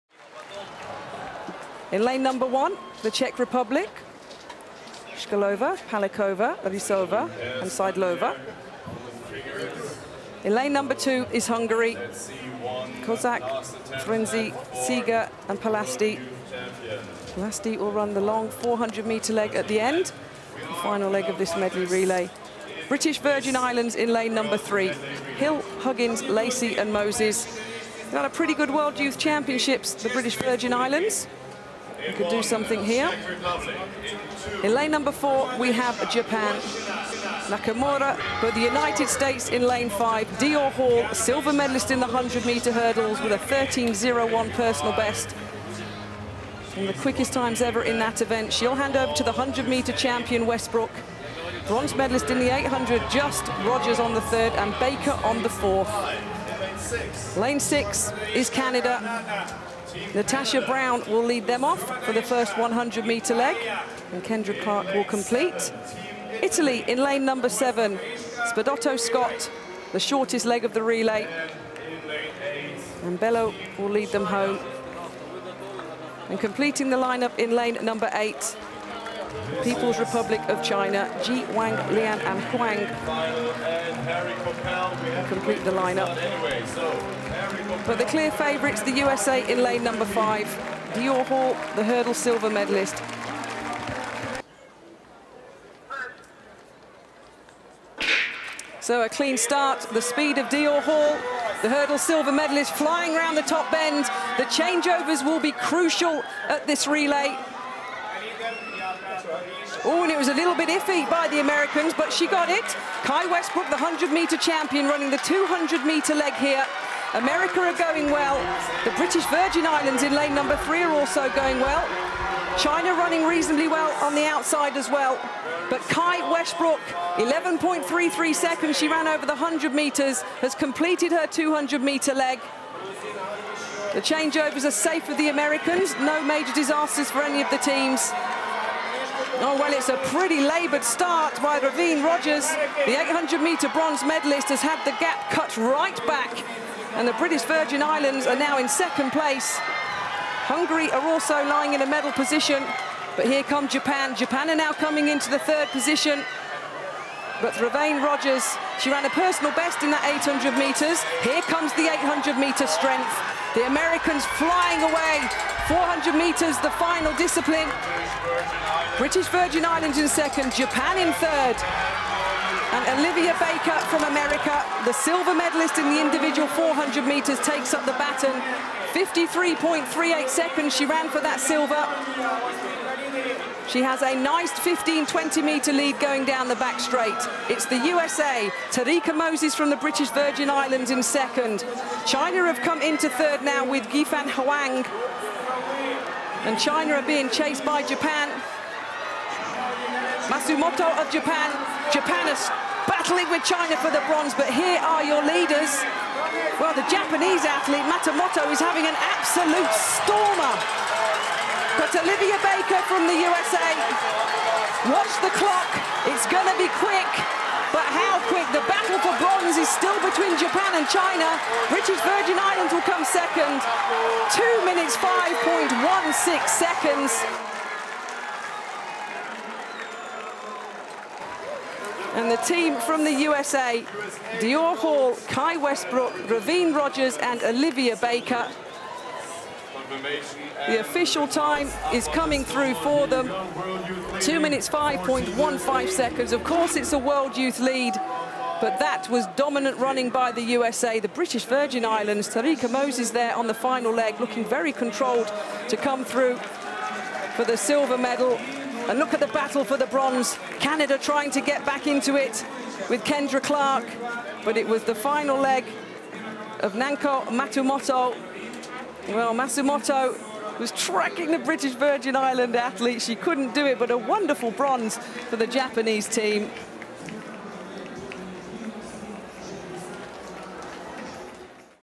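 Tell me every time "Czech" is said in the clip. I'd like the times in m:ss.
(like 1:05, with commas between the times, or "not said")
0:03.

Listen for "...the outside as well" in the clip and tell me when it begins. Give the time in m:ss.
2:04.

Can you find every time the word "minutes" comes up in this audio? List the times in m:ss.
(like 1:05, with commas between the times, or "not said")
3:44, 4:04.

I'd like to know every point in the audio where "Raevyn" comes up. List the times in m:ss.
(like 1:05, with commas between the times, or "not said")
2:21, 2:37, 3:56.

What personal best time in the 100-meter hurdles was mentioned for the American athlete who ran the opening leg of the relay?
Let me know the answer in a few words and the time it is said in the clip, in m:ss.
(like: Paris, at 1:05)
13.01, at 0:43.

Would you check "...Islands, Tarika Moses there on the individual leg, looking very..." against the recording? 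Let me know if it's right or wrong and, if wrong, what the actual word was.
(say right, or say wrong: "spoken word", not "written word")
wrong: "final", not "individual".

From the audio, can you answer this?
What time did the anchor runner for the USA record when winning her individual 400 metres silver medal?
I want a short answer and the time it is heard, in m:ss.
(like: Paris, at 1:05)
53.38 seconds, at 2:58.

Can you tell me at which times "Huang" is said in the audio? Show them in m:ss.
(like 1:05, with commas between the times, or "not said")
1:22, 3:14.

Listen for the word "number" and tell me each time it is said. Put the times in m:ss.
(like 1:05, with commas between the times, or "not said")
0:02, 0:10, 0:24, 0:34, 1:07, 1:17, 1:29, 2:00.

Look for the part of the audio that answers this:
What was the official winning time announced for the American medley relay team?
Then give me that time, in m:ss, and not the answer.
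4:04.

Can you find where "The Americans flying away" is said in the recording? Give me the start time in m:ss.
2:43.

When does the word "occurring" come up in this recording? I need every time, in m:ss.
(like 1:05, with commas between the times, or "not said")
not said.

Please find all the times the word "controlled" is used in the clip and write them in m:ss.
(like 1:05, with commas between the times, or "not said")
4:14.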